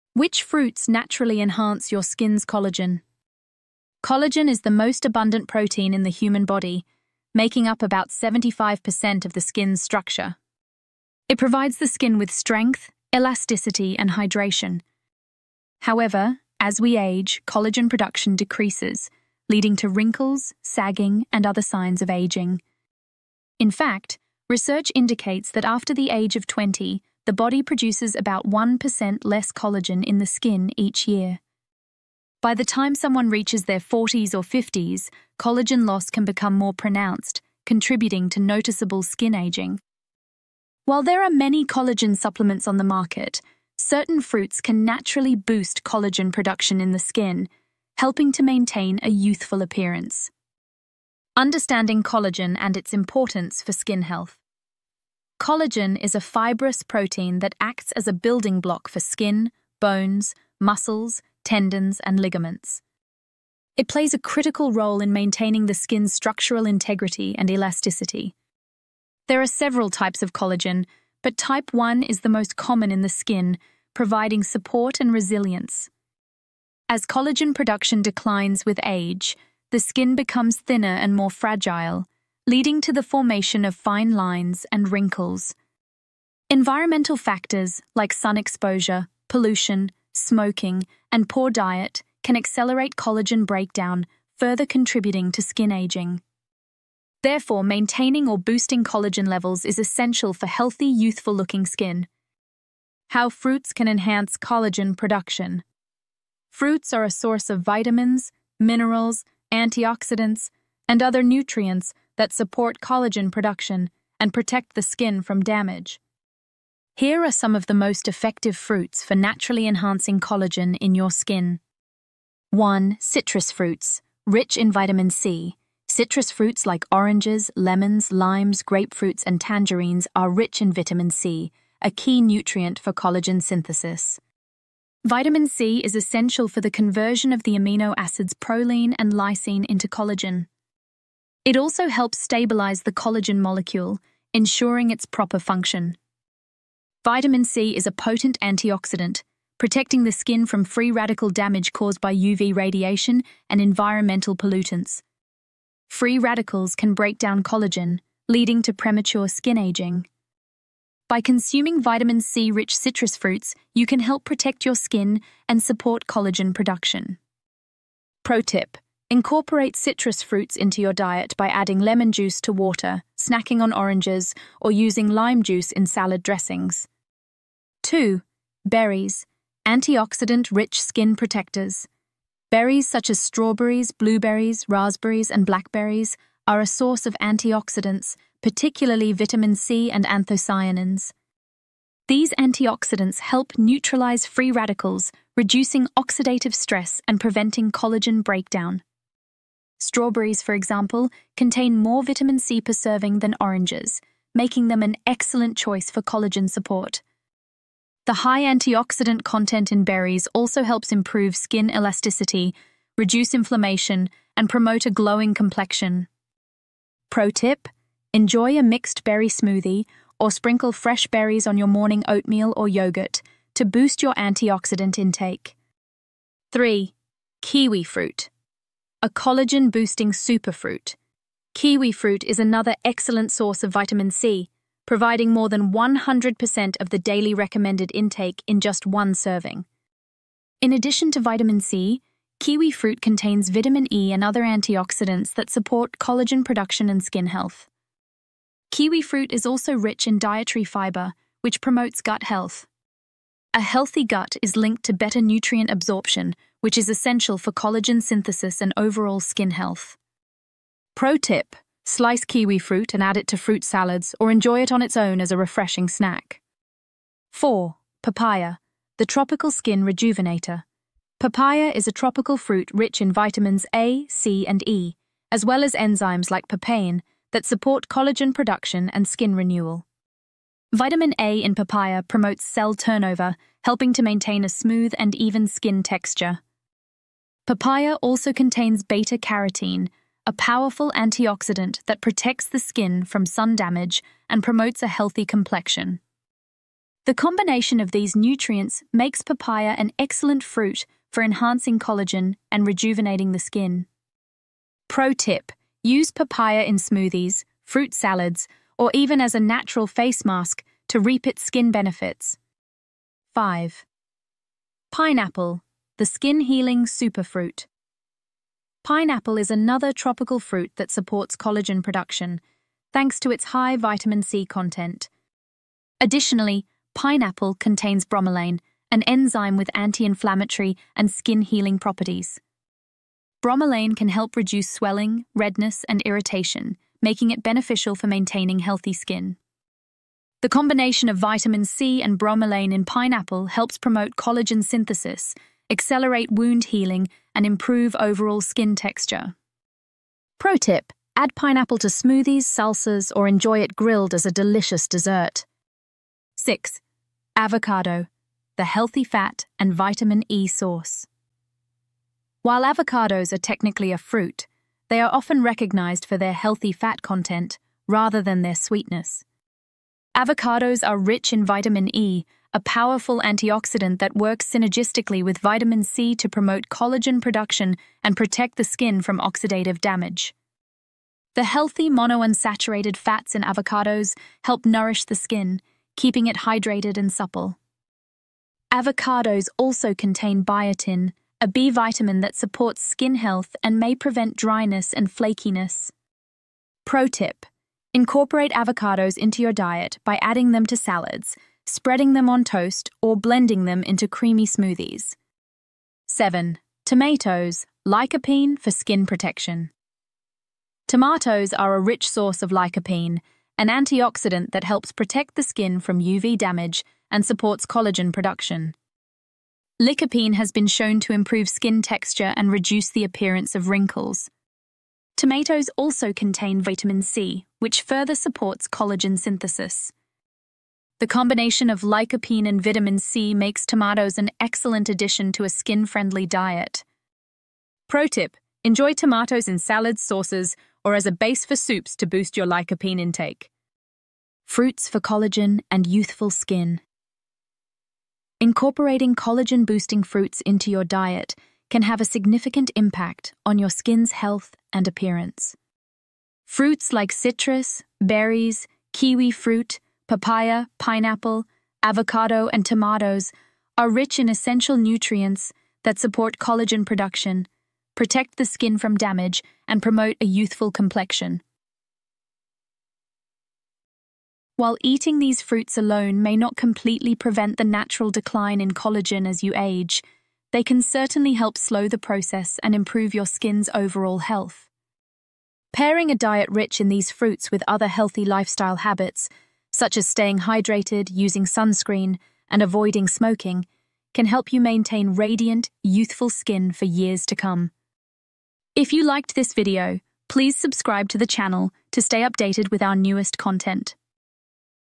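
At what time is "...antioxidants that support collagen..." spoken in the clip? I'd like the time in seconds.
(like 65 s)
244 s.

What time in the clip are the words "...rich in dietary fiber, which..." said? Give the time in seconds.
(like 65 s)
249 s.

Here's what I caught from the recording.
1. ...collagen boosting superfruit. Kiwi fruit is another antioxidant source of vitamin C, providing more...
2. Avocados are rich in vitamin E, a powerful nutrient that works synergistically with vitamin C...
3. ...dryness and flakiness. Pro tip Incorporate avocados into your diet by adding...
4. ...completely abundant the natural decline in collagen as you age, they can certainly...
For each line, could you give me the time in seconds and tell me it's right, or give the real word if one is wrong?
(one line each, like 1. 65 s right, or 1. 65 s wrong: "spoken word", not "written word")
1. 229 s wrong: "excellent", not "antioxidant"
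2. 370 s wrong: "antioxidant", not "nutrient"
3. 394 s right
4. 476 s wrong: "prevent", not "abundant".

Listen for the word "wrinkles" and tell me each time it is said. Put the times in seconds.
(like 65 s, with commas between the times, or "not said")
19 s, 84 s, 423 s.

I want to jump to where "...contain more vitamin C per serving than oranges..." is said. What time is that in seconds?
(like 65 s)
201 s.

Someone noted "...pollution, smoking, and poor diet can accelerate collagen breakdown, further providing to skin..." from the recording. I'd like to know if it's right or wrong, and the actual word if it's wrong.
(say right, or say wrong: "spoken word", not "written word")
wrong: "contributing", not "providing".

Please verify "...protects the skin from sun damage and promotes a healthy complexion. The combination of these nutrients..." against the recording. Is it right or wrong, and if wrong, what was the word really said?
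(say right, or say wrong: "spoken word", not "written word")
right.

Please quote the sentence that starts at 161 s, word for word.
By consuming vitamin C rich citrus fruits, you can help protect your skin and support collagen production.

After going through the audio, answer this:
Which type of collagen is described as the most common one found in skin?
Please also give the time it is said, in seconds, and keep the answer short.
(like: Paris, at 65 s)
Type 1, at 71 s.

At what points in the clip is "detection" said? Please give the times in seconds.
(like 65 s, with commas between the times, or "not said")
not said.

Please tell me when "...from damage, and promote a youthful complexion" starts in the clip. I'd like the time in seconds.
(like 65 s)
468 s.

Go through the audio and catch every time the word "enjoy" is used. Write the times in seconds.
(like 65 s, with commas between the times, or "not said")
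218 s, 264 s, 353 s, 438 s.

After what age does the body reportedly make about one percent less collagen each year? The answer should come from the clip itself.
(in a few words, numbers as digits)
20.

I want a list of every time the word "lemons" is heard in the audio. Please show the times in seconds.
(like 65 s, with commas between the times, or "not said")
127 s, 171 s.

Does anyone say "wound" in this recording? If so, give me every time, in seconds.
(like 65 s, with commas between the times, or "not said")
346 s.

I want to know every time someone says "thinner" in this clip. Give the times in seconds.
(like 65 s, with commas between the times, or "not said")
80 s.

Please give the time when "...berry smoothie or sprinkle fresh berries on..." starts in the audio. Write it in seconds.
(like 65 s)
219 s.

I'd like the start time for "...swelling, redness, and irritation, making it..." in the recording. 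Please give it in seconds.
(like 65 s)
334 s.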